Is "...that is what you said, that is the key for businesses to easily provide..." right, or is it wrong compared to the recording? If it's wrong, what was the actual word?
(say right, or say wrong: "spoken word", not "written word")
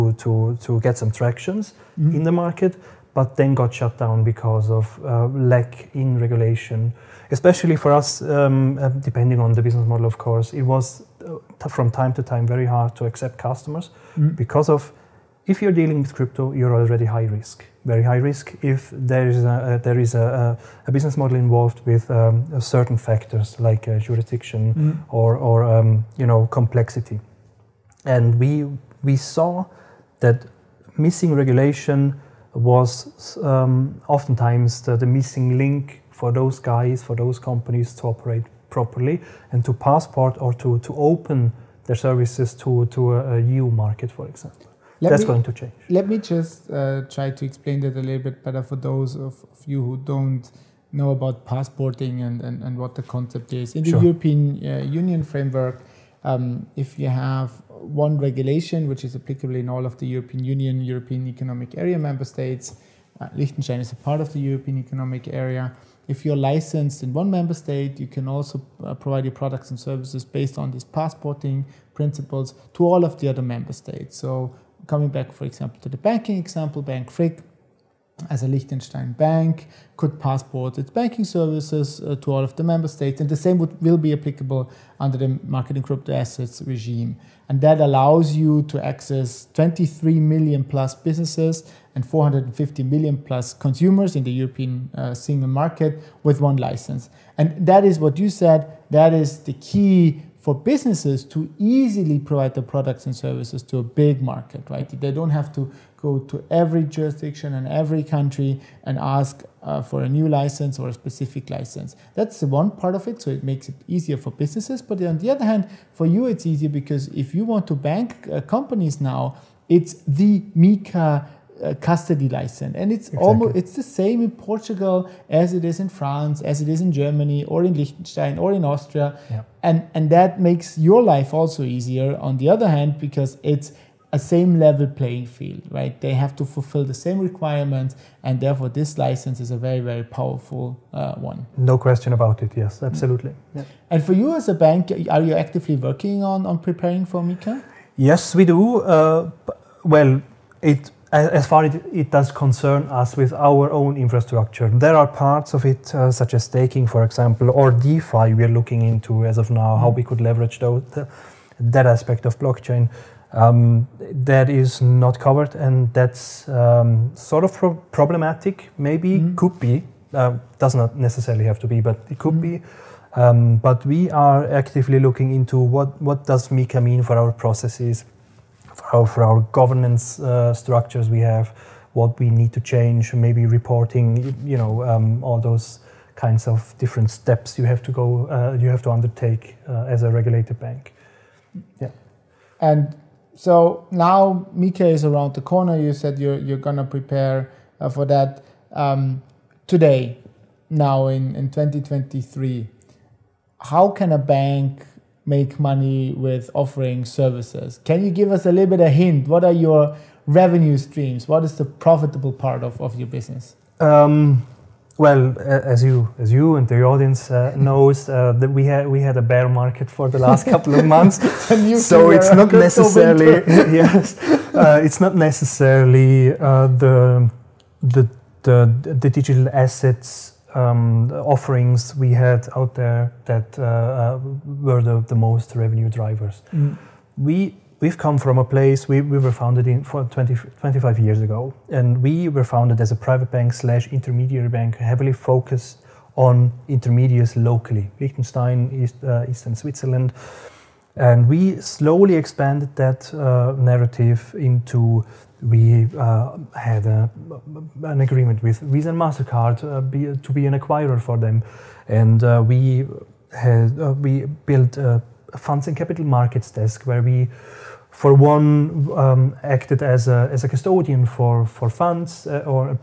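right.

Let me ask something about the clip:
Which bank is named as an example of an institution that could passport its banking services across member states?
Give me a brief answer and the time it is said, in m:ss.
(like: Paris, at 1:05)
Bank Frick, at 1:16.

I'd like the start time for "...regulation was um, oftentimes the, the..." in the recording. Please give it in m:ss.
0:31.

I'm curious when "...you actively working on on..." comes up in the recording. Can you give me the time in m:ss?
2:25.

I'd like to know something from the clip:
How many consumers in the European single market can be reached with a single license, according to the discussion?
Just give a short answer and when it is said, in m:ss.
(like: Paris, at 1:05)
450 million plus, at 1:32.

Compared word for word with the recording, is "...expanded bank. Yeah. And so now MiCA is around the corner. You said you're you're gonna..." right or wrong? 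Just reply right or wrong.
wrong.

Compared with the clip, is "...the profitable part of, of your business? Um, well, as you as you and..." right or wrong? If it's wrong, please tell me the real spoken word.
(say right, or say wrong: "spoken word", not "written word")
right.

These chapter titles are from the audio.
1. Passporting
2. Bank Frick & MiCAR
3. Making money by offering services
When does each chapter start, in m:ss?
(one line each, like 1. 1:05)
1. 0:45
2. 2:23
3. 3:23.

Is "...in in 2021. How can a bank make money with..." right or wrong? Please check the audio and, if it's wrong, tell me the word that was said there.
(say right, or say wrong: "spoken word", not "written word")
wrong: "2023", not "2021".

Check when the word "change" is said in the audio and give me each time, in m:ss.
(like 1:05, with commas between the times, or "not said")
0:45, 3:02.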